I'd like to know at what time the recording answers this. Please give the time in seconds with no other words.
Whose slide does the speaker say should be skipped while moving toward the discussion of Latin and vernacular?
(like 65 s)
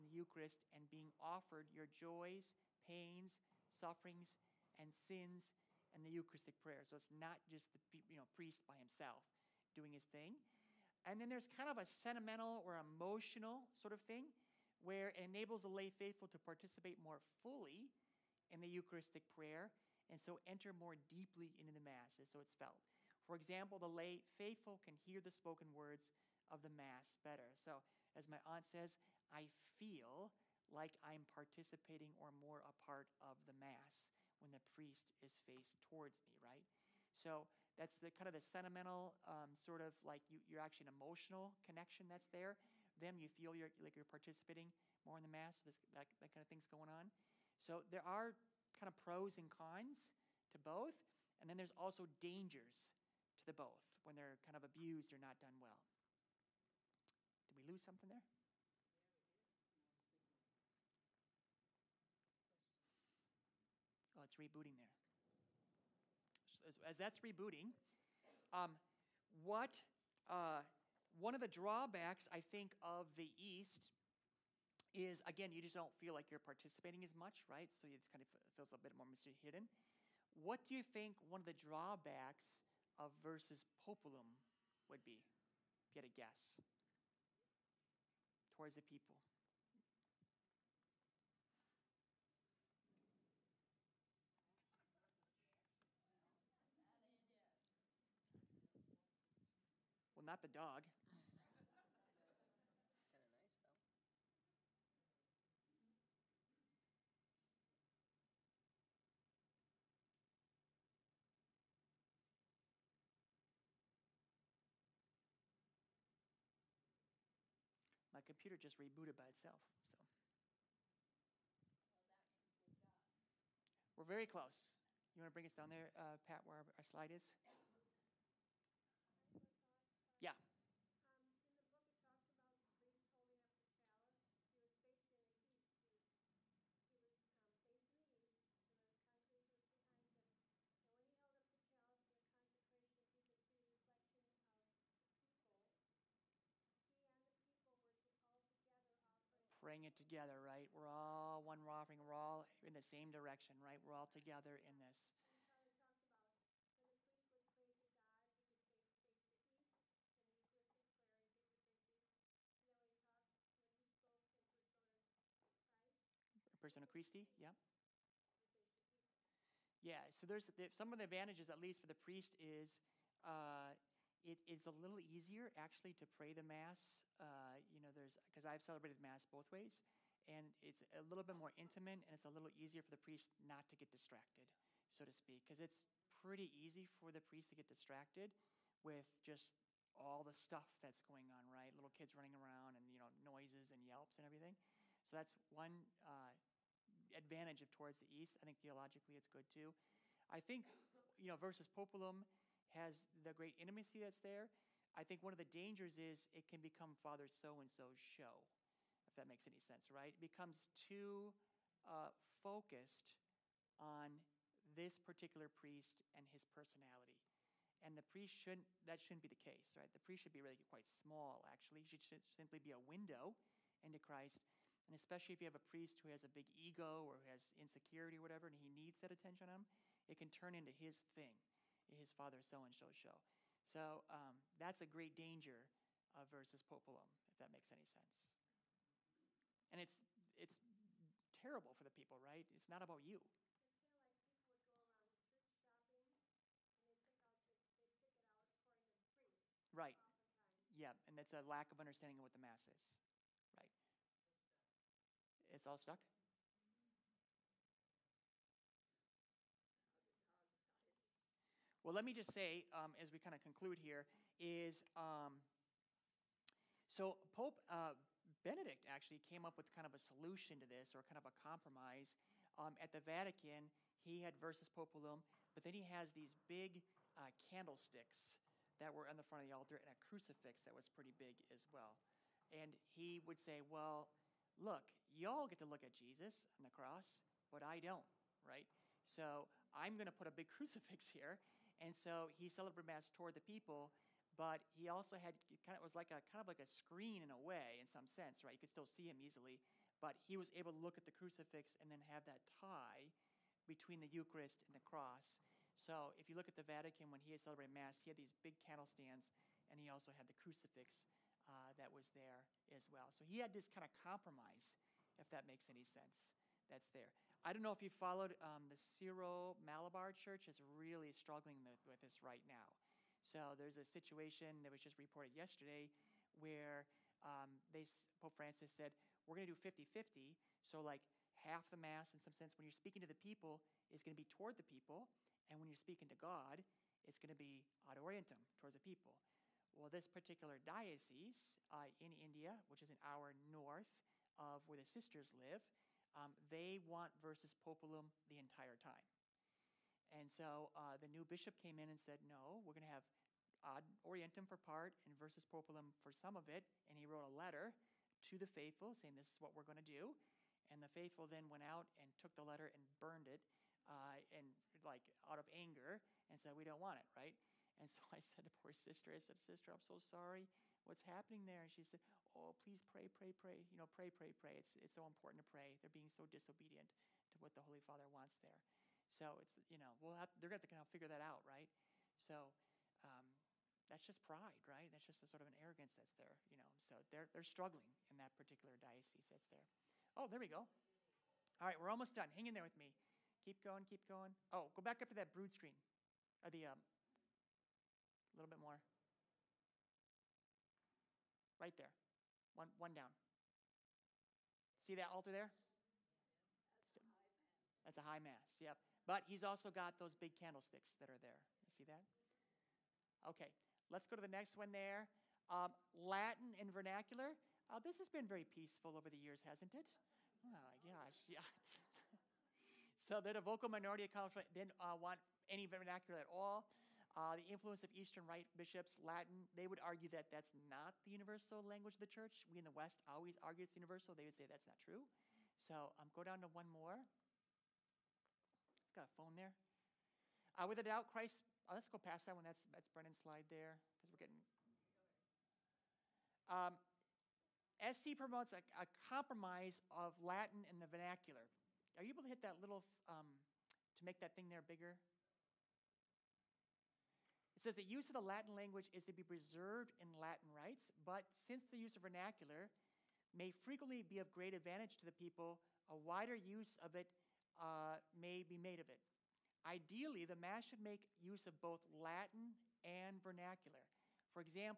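442 s.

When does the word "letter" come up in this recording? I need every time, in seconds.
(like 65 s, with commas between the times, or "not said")
357 s, 362 s.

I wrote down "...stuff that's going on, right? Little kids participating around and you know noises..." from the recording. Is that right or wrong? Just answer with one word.
wrong.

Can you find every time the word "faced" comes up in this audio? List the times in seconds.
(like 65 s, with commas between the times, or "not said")
35 s.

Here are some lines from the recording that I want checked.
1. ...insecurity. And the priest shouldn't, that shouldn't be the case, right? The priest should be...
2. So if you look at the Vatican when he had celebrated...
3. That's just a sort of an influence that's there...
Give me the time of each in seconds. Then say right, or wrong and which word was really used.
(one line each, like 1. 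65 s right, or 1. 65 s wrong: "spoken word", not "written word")
1. 216 s wrong: "personality", not "insecurity"
2. 305 s right
3. 384 s wrong: "arrogance", not "influence".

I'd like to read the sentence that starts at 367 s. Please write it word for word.
And so I said to poor sister, I said, Sister, I'm so sorry.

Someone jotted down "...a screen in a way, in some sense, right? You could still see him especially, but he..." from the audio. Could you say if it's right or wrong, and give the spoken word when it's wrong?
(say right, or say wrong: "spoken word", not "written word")
wrong: "easily", not "especially".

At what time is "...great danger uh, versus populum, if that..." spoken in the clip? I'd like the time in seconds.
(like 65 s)
234 s.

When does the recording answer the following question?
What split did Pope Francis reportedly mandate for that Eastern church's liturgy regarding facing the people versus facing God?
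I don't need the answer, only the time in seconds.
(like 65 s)
329 s.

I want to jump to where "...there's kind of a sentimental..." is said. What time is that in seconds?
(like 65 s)
11 s.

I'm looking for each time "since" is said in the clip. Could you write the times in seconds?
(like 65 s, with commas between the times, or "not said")
461 s.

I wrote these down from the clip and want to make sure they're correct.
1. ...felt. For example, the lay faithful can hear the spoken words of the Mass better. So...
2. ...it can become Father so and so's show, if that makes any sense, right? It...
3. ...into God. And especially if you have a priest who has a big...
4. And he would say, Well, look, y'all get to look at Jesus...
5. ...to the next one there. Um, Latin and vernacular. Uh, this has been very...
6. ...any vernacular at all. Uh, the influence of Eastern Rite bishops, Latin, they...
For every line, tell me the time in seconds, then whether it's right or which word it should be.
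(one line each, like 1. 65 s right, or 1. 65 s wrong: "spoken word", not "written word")
1. 22 s right
2. 206 s right
3. 223 s wrong: "Christ", not "God"
4. 282 s right
5. 414 s right
6. 425 s right.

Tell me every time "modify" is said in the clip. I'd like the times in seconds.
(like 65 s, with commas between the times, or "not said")
not said.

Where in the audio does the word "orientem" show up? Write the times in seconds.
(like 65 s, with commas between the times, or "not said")
337 s, 354 s.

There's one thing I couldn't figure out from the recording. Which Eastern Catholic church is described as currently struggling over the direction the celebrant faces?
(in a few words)
Syro Malabar Church.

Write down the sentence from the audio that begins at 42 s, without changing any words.
Then you feel you're like you're participating more in the mass.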